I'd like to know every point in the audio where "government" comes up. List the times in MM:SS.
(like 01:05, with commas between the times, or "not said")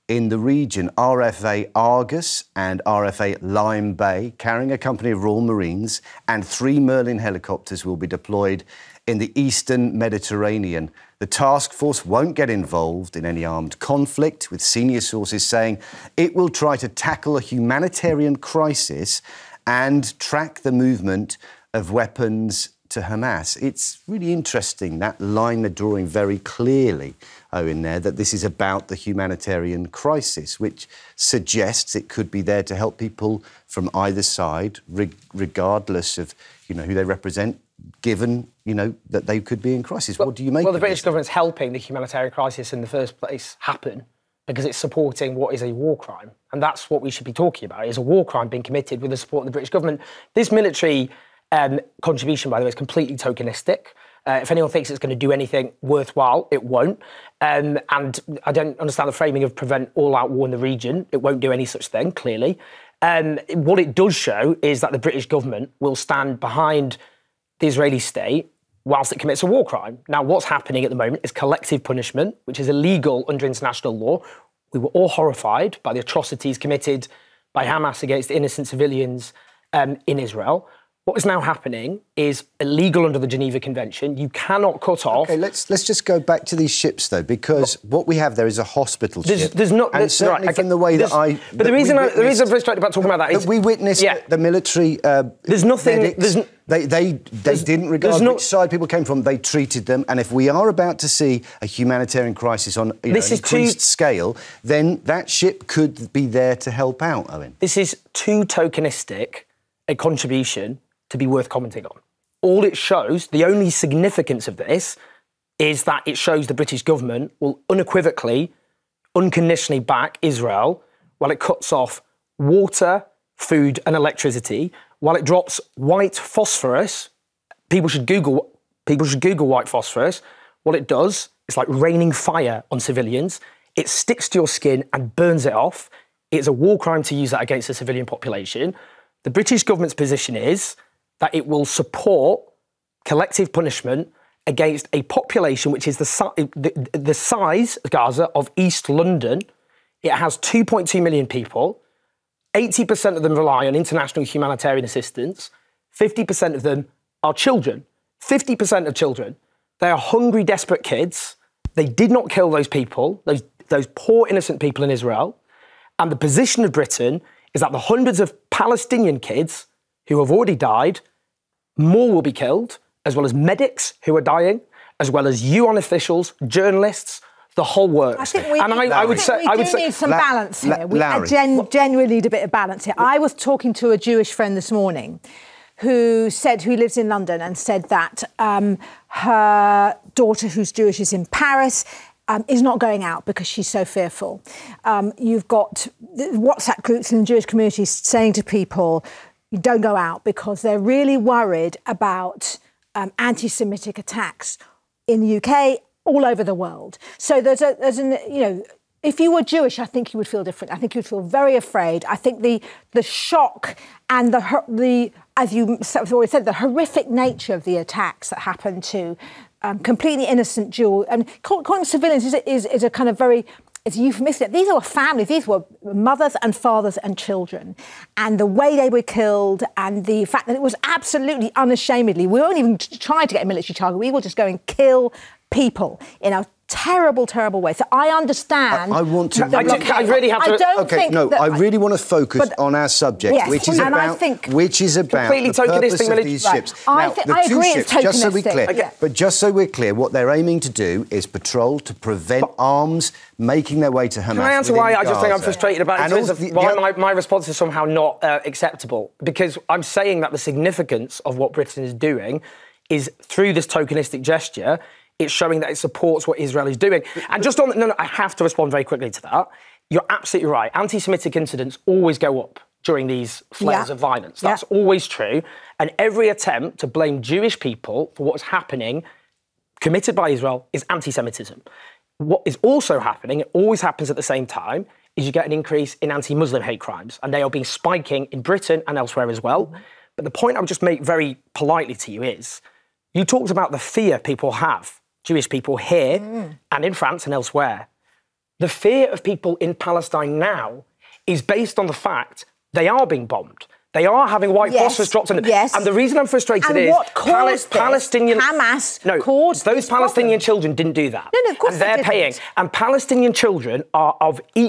00:41, 00:49, 01:05, 01:56, 02:19.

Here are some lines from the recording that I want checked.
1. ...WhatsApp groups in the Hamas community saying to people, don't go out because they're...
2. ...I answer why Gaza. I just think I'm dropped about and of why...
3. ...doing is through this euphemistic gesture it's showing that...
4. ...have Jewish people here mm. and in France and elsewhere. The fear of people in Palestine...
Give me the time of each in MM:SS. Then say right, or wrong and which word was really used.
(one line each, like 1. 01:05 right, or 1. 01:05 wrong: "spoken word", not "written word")
1. 03:16 wrong: "Jewish", not "Hamas"
2. 04:14 wrong: "frustrated", not "dropped"
3. 04:21 wrong: "tokenistic", not "euphemistic"
4. 04:54 right.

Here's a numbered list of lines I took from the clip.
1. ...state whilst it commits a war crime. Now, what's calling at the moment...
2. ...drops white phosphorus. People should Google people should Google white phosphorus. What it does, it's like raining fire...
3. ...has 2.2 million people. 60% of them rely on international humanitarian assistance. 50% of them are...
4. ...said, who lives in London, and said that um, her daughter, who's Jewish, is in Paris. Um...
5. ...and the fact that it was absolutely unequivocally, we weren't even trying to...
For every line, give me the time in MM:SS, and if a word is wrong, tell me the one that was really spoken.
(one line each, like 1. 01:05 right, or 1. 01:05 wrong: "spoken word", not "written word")
1. 01:07 wrong: "happening", not "calling"
2. 02:05 right
3. 02:30 wrong: "80", not "60"
4. 03:06 right
5. 03:49 wrong: "unashamedly", not "unequivocally".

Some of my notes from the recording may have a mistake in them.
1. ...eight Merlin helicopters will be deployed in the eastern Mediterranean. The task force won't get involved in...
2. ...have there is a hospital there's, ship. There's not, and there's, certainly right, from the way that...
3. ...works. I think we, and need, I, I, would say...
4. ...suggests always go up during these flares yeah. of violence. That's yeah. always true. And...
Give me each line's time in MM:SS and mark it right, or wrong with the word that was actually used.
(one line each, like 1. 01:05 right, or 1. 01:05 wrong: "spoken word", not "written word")
1. 00:06 wrong: "three", not "eight"
2. 01:28 right
3. 02:57 right
4. 04:31 wrong: "incidents", not "suggests".